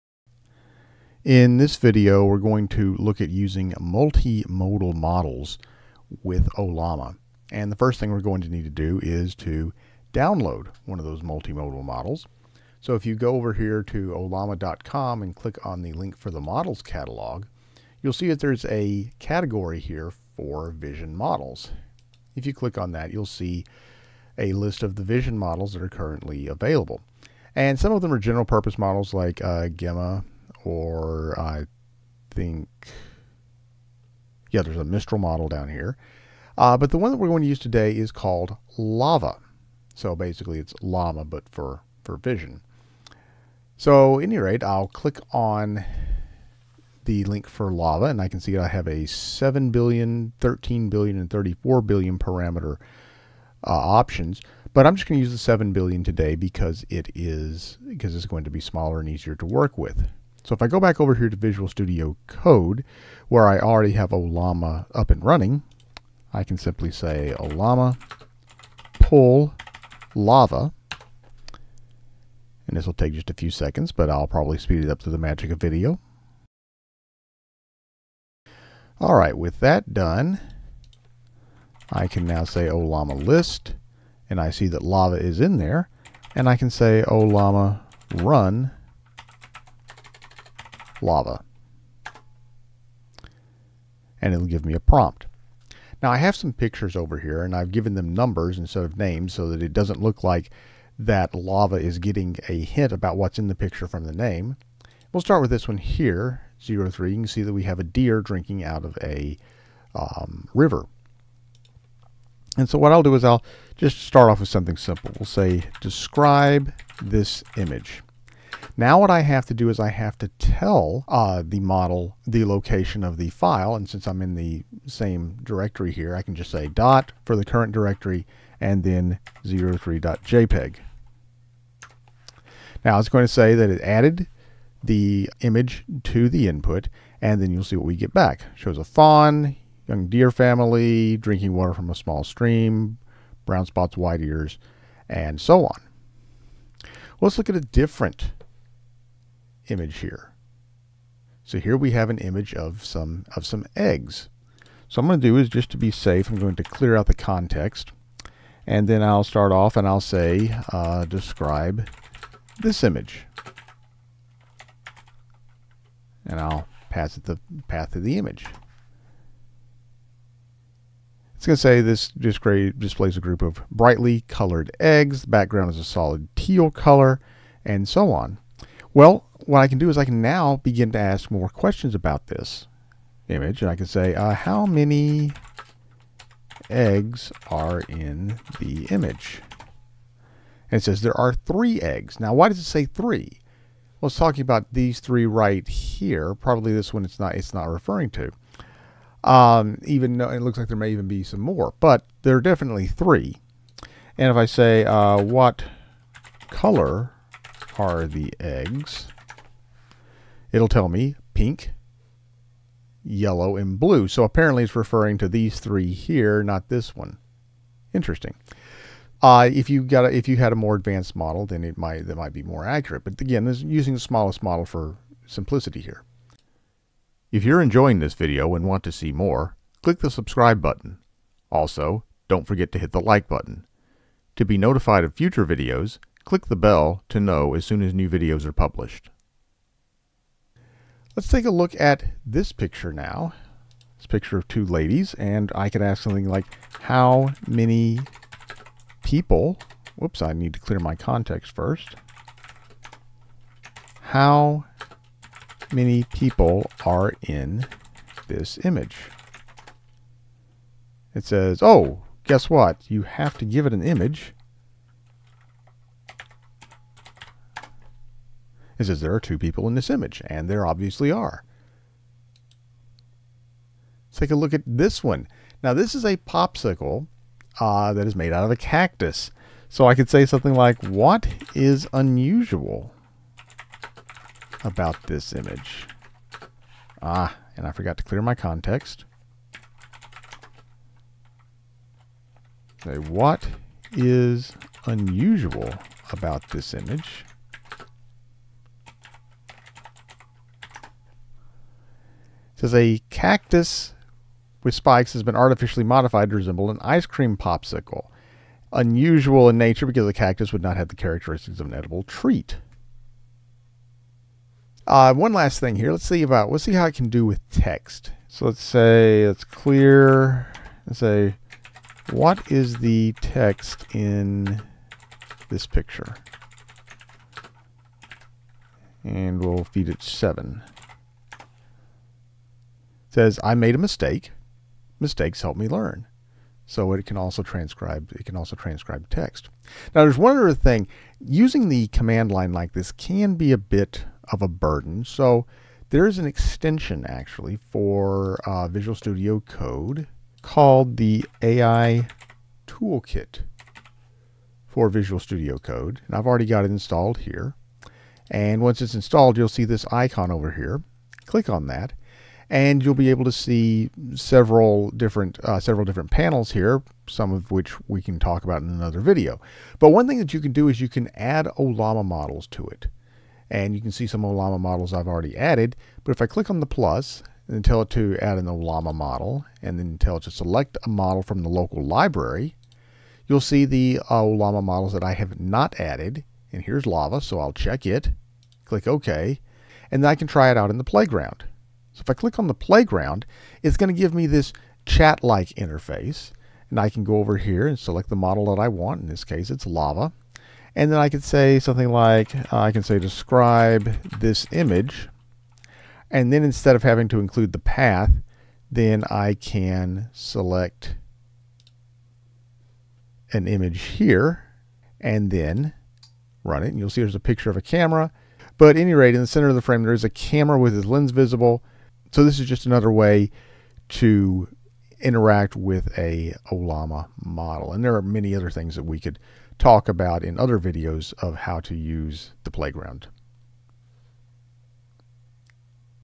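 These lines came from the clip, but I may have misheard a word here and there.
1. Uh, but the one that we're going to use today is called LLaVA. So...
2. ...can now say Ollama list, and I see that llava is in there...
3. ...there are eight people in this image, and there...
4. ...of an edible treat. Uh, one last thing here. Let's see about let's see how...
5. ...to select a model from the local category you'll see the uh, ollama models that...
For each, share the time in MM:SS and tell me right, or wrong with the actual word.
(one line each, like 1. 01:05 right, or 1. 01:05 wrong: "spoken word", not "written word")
1. 00:36 right
2. 01:22 right
3. 04:29 wrong: "two", not "eight"
4. 05:11 right
5. 06:20 wrong: "library", not "category".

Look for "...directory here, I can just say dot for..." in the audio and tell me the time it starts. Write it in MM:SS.
02:05.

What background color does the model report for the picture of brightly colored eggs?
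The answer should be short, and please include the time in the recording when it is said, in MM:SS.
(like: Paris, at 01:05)
teal, at 02:56.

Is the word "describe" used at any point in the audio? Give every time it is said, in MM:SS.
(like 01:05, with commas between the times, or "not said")
01:55, 02:41, 06:42.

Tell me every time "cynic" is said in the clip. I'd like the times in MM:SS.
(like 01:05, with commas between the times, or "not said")
not said.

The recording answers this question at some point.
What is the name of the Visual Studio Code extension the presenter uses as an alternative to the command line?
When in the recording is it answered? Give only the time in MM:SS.
05:51.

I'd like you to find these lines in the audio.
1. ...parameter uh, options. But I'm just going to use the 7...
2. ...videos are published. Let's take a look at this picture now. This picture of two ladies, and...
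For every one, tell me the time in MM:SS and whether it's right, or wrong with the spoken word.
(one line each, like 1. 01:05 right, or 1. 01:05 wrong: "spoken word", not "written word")
1. 00:52 right
2. 03:58 right.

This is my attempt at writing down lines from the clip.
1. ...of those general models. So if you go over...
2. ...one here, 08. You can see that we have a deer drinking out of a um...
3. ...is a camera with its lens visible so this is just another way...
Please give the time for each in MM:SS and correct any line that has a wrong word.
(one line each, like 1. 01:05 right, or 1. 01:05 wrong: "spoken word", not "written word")
1. 00:10 wrong: "multimodal", not "general"
2. 01:45 wrong: "03", not "08"
3. 06:59 right.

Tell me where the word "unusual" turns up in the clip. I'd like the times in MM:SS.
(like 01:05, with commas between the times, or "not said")
04:41, 04:54, 05:08.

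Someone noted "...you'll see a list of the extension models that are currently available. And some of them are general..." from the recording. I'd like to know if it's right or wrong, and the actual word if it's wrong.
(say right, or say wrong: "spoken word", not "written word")
wrong: "vision", not "extension".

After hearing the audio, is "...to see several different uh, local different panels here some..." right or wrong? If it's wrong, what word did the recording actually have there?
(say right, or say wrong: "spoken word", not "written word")
wrong: "several", not "local".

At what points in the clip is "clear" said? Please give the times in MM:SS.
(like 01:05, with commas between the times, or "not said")
02:36, 04:10, 04:48, 05:19.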